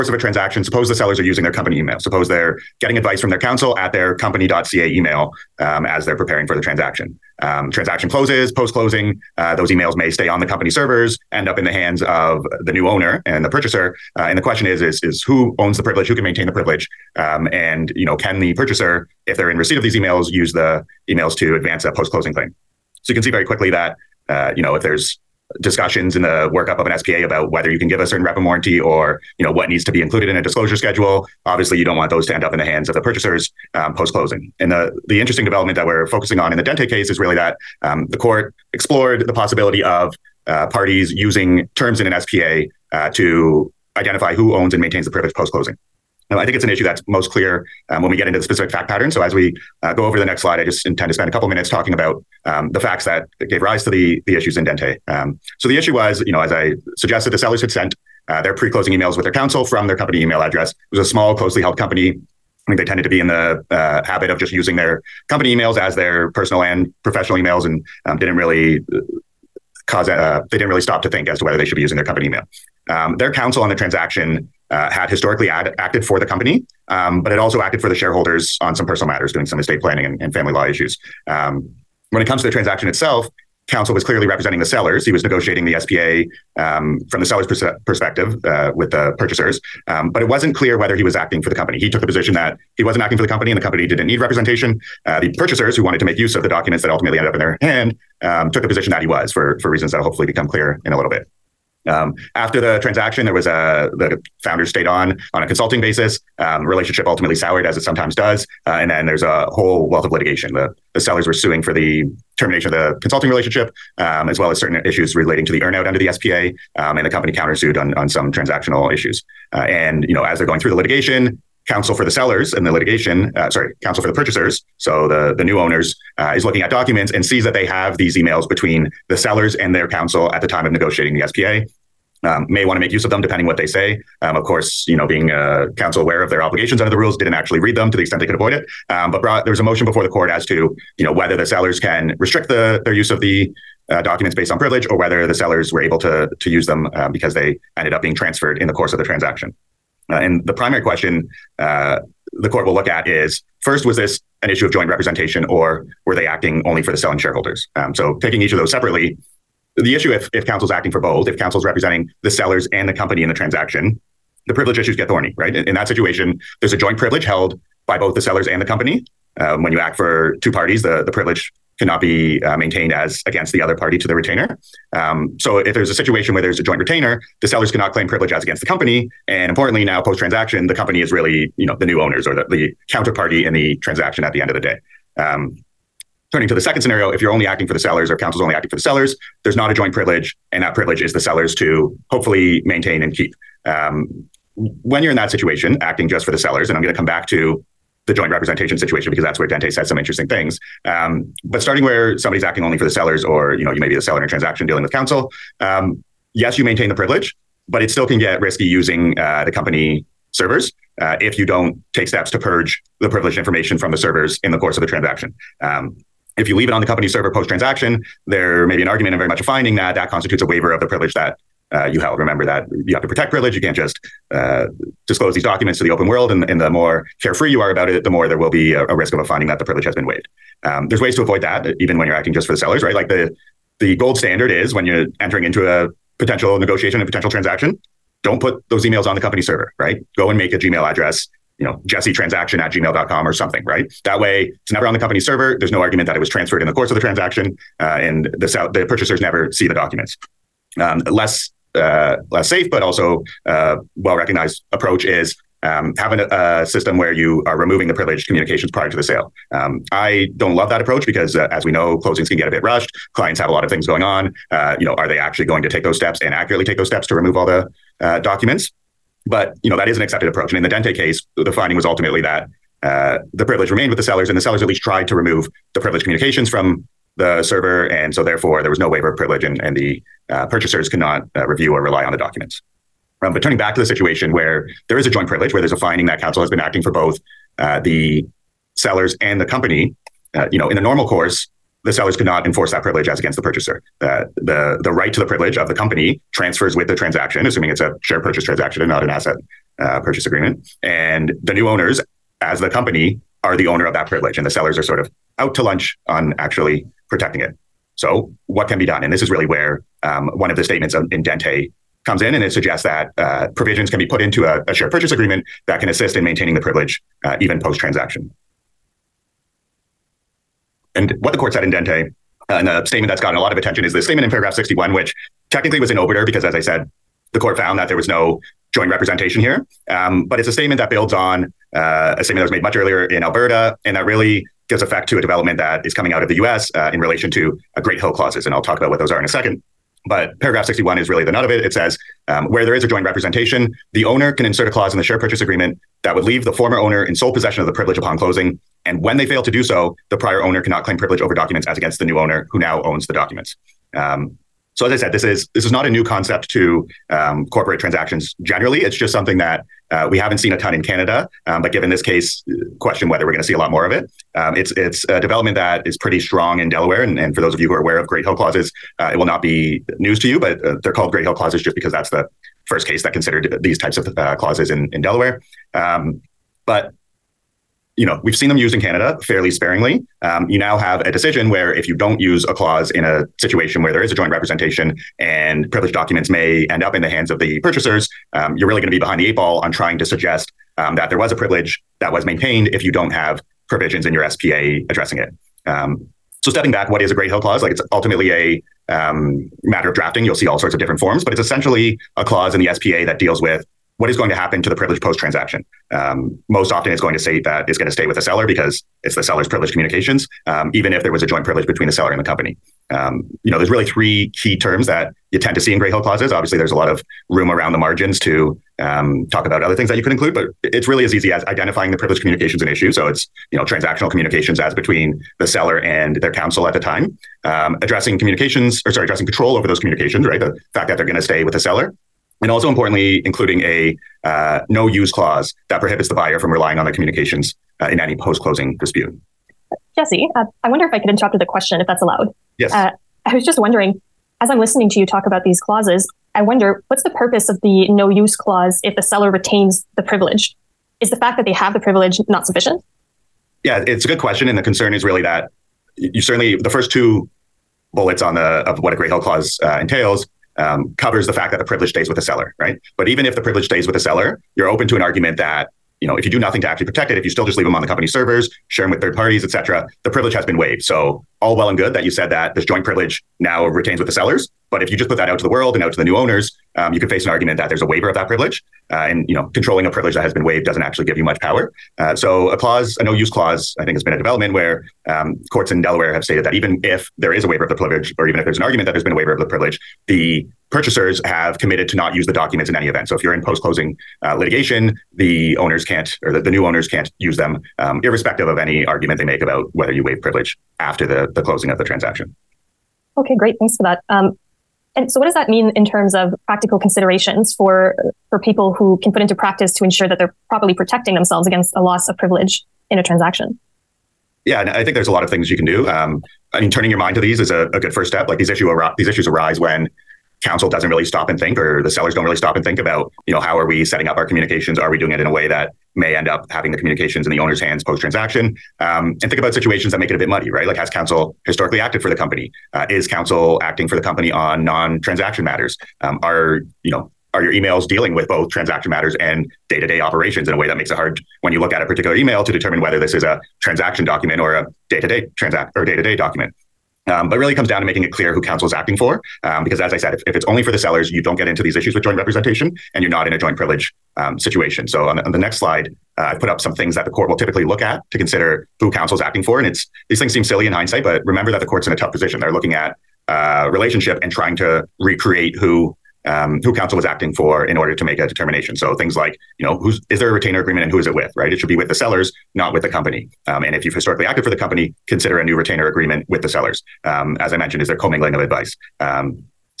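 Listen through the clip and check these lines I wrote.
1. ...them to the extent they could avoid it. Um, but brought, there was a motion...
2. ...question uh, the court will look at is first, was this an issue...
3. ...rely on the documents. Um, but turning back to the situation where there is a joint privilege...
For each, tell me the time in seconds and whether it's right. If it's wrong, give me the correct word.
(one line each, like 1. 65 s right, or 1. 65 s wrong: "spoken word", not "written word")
1. 137 s right
2. 150 s right
3. 281 s right.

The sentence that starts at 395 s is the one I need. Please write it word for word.
Um, so stepping back, what is a Great Hill clause?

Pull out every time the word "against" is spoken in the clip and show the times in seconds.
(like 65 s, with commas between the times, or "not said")
173 s, 178 s, 293 s, 351 s, 511 s.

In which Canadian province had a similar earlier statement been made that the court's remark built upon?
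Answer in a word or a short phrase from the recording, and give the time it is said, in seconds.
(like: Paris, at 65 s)
Alberta, at 333 s.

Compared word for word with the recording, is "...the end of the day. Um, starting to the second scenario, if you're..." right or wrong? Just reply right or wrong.
wrong.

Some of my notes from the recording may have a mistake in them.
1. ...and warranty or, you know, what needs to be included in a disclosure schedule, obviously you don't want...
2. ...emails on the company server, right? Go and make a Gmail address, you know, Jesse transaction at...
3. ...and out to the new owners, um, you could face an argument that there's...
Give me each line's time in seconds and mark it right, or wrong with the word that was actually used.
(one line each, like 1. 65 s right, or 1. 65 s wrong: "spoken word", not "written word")
1. 28 s right
2. 238 s right
3. 475 s right.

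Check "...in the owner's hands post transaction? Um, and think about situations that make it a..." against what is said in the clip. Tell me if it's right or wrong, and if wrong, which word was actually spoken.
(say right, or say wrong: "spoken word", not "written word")
right.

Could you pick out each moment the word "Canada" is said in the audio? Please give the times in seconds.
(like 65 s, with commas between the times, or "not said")
360 s, 378 s.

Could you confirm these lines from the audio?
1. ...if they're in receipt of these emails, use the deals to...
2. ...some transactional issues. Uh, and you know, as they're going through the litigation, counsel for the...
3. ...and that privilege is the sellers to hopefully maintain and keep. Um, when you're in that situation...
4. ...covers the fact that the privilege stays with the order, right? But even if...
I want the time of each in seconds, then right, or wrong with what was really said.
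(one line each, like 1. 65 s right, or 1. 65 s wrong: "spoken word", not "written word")
1. 19 s wrong: "emails", not "deals"
2. 118 s right
3. 190 s right
4. 460 s wrong: "seller", not "order".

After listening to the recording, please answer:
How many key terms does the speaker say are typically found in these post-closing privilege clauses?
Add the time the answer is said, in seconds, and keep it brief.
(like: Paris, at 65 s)
3, at 413 s.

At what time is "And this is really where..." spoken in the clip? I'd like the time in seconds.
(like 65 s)
309 s.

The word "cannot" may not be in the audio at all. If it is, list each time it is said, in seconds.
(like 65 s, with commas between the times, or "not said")
171 s, 177 s, 350 s.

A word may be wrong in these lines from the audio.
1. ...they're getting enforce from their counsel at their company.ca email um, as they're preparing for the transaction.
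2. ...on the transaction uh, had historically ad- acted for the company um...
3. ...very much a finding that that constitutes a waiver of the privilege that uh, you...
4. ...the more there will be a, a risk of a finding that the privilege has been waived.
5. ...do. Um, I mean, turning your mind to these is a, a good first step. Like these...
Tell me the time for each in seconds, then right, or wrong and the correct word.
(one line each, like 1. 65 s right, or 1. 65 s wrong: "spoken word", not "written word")
1. 2 s wrong: "advice", not "enforce"
2. 73 s right
3. 219 s right
4. 228 s right
5. 515 s right.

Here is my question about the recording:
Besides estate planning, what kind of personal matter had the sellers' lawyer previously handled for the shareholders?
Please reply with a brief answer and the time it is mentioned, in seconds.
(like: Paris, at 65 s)
Family law, at 80 s.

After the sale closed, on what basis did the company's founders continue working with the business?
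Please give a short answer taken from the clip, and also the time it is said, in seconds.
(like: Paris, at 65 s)
Consulting basis, at 105 s.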